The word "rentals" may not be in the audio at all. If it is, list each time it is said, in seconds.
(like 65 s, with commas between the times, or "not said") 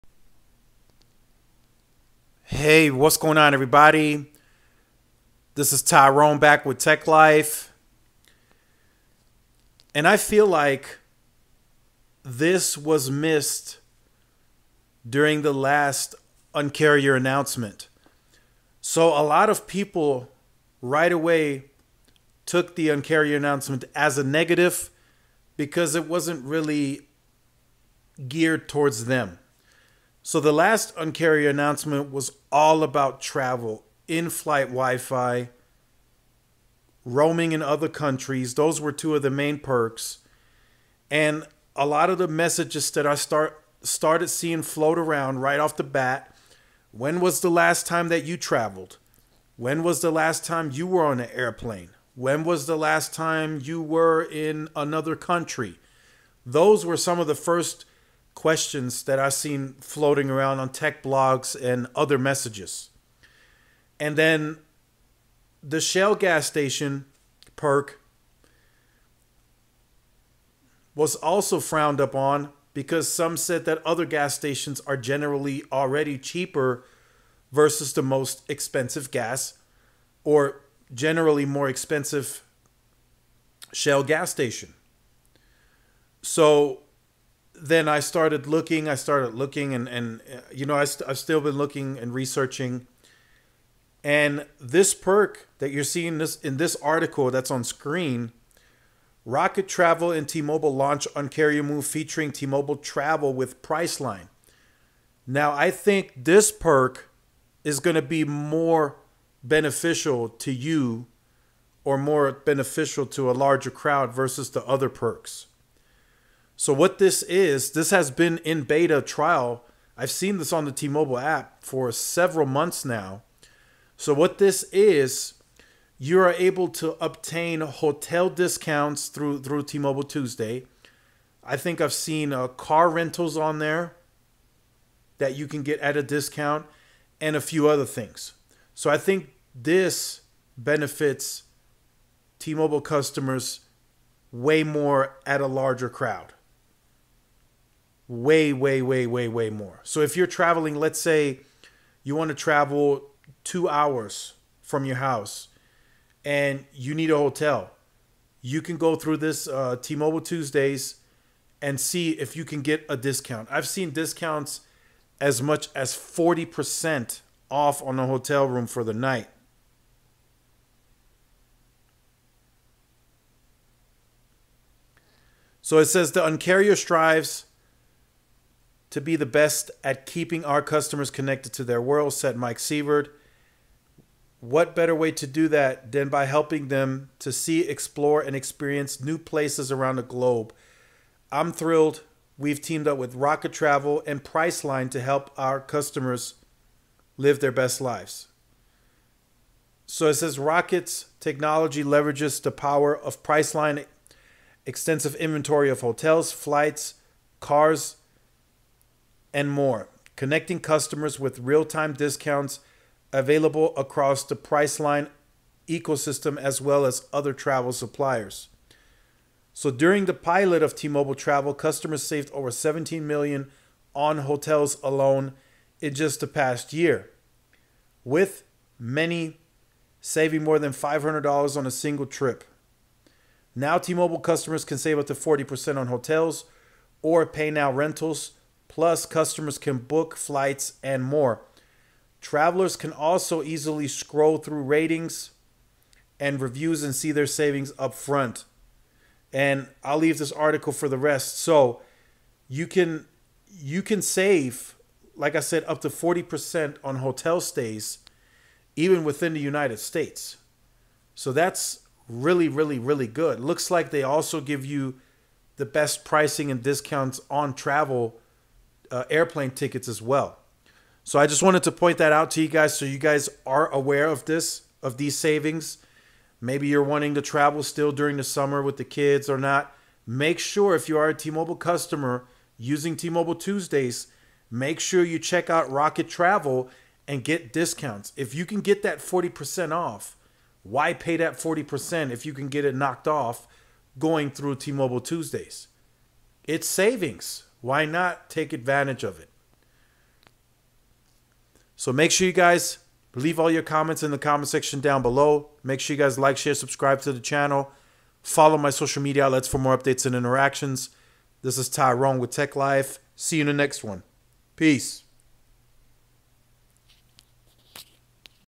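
132 s, 237 s.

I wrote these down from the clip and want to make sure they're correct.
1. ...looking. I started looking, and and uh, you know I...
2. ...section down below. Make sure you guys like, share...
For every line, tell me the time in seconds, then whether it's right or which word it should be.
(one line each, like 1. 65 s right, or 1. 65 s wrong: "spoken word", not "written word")
1. 88 s right
2. 304 s right.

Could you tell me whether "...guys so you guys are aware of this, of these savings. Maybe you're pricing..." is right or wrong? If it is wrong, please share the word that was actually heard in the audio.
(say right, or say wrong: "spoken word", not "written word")
wrong: "wanting", not "pricing".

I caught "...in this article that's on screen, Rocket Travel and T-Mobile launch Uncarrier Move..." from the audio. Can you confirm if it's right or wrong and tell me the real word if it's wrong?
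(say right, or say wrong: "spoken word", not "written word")
right.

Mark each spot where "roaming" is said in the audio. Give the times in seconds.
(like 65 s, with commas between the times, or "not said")
37 s.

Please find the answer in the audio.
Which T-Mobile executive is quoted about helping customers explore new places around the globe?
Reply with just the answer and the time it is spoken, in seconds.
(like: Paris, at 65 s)
Mike Sievert, at 182 s.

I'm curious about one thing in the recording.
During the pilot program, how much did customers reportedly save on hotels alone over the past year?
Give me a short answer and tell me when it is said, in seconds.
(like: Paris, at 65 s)
17 million, at 222 s.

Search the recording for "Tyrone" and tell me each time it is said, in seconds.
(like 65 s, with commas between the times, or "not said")
5 s, 311 s.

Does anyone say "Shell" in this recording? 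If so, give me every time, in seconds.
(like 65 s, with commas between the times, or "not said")
65 s, 83 s.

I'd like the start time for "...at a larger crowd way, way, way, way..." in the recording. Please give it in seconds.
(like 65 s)
145 s.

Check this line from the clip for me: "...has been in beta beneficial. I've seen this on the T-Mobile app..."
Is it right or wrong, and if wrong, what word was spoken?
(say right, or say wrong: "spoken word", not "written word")
wrong: "trial", not "beneficial".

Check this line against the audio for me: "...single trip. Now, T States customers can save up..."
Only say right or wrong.
wrong.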